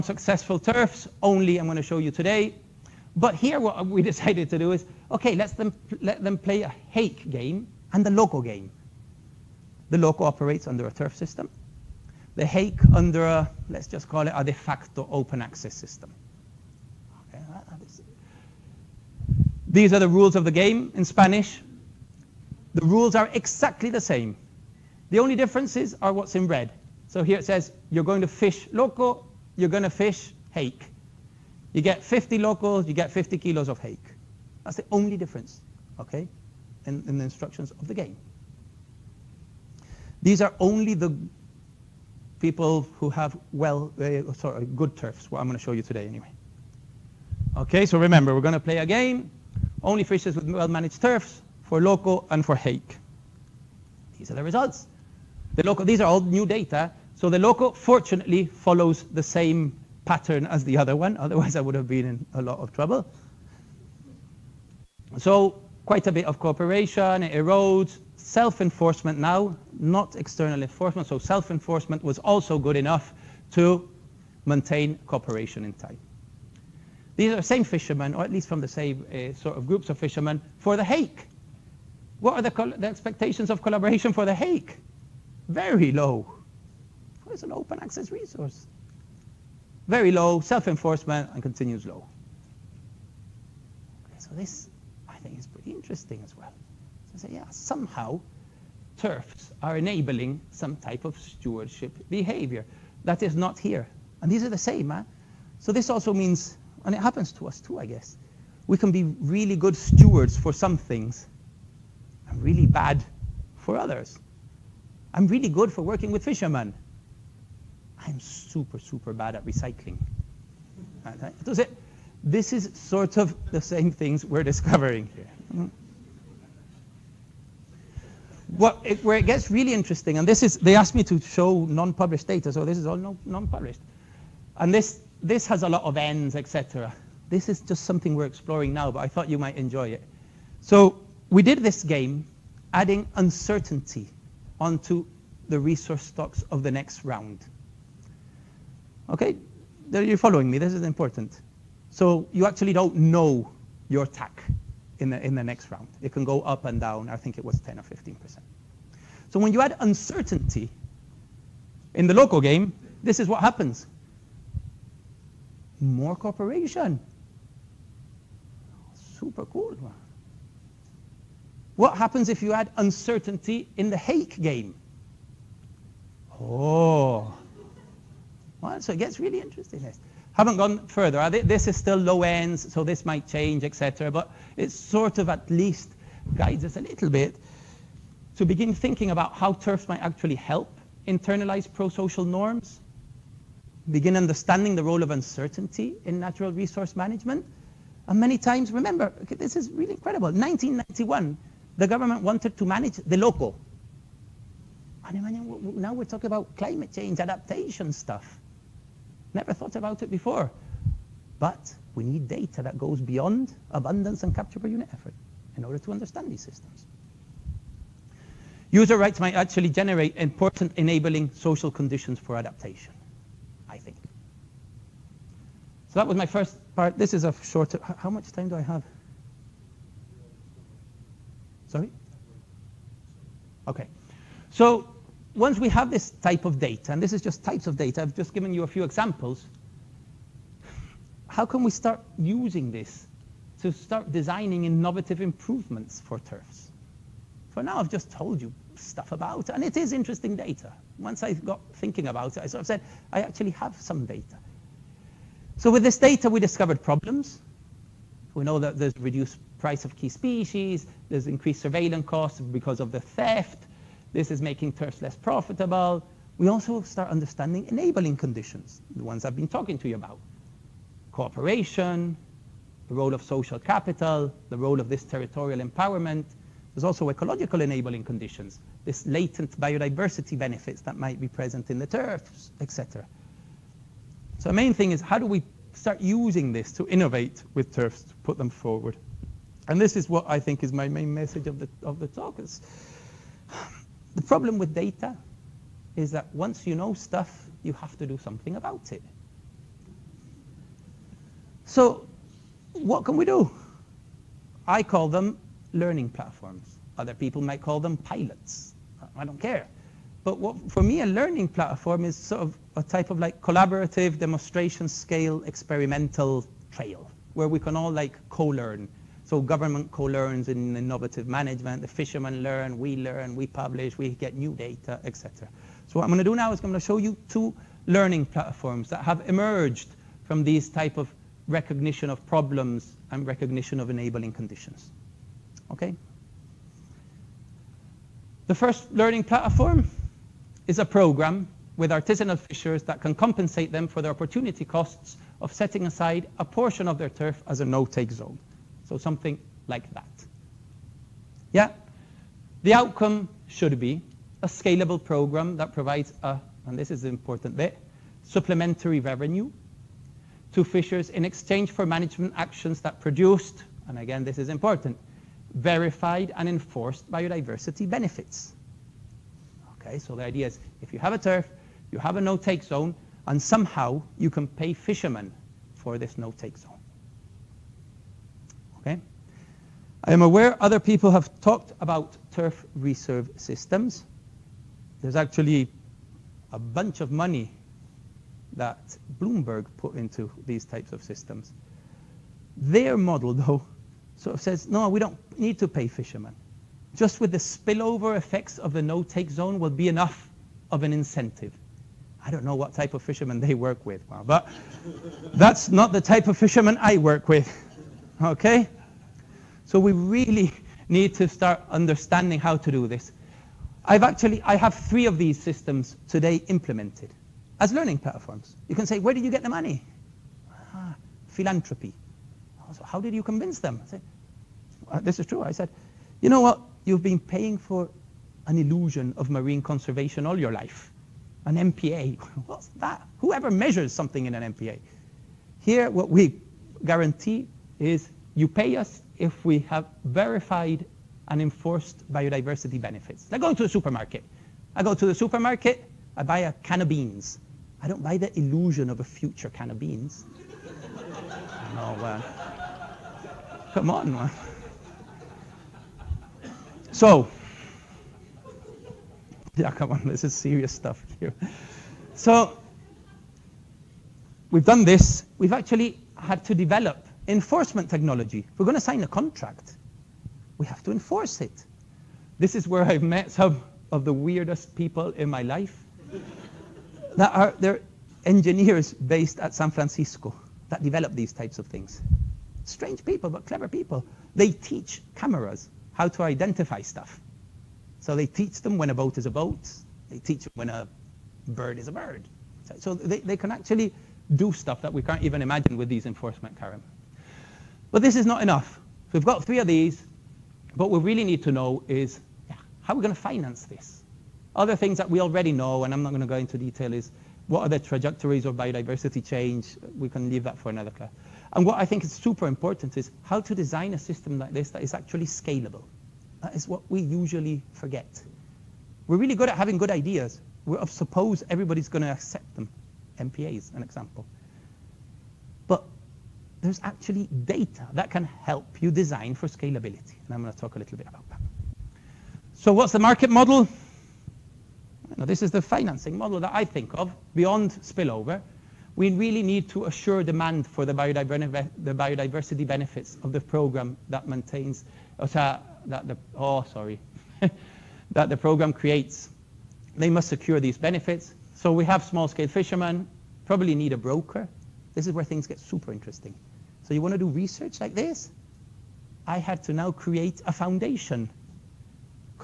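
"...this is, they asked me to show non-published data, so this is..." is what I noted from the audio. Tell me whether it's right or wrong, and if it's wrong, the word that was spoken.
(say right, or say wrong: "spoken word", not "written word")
right.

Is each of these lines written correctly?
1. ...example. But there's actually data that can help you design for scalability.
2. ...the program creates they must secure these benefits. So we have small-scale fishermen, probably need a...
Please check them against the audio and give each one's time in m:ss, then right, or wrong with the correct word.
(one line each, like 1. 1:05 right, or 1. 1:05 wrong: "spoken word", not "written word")
1. 8:43 right
2. 9:08 right.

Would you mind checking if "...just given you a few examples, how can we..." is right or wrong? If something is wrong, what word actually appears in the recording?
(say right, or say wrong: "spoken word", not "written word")
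right.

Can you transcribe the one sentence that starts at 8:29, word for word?
We can leave that for another class.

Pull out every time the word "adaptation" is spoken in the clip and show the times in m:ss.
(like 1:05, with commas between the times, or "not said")
3:27, 3:42.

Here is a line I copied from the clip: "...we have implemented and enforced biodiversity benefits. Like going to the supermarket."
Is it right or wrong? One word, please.
wrong.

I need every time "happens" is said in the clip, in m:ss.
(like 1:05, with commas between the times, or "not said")
1:46, 2:43, 2:51.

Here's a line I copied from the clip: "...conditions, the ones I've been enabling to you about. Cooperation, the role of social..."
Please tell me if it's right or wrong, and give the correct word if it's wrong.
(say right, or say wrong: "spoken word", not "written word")
wrong: "talking", not "enabling".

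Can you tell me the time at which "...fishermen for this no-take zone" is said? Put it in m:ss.
6:14.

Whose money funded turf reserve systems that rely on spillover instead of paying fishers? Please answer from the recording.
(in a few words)
Bloomberg.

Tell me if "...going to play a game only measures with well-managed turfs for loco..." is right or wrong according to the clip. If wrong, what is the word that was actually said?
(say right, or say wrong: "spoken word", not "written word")
wrong: "fishes", not "measures".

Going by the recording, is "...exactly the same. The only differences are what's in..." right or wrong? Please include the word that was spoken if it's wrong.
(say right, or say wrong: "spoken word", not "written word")
right.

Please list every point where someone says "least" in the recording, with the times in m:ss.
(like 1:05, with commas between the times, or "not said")
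1:18, 3:05.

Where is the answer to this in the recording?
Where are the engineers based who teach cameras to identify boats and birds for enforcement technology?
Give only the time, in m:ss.
7:59.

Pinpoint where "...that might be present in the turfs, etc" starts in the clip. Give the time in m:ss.
4:40.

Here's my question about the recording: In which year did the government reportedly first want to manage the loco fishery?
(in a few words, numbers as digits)
1991.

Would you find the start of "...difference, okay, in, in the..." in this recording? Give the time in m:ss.
0:35.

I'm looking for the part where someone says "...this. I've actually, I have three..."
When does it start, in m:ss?
6:52.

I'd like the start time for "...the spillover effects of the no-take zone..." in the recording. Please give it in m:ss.
6:37.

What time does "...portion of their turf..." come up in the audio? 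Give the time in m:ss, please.
5:46.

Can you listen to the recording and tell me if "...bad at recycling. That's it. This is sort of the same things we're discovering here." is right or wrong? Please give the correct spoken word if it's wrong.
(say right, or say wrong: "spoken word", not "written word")
right.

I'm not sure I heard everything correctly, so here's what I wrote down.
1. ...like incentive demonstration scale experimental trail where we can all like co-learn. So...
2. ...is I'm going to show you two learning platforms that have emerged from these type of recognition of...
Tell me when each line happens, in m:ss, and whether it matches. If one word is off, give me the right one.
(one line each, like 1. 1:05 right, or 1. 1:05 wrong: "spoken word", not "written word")
1. 5:13 wrong: "collaborative", not "incentive"
2. 5:26 right.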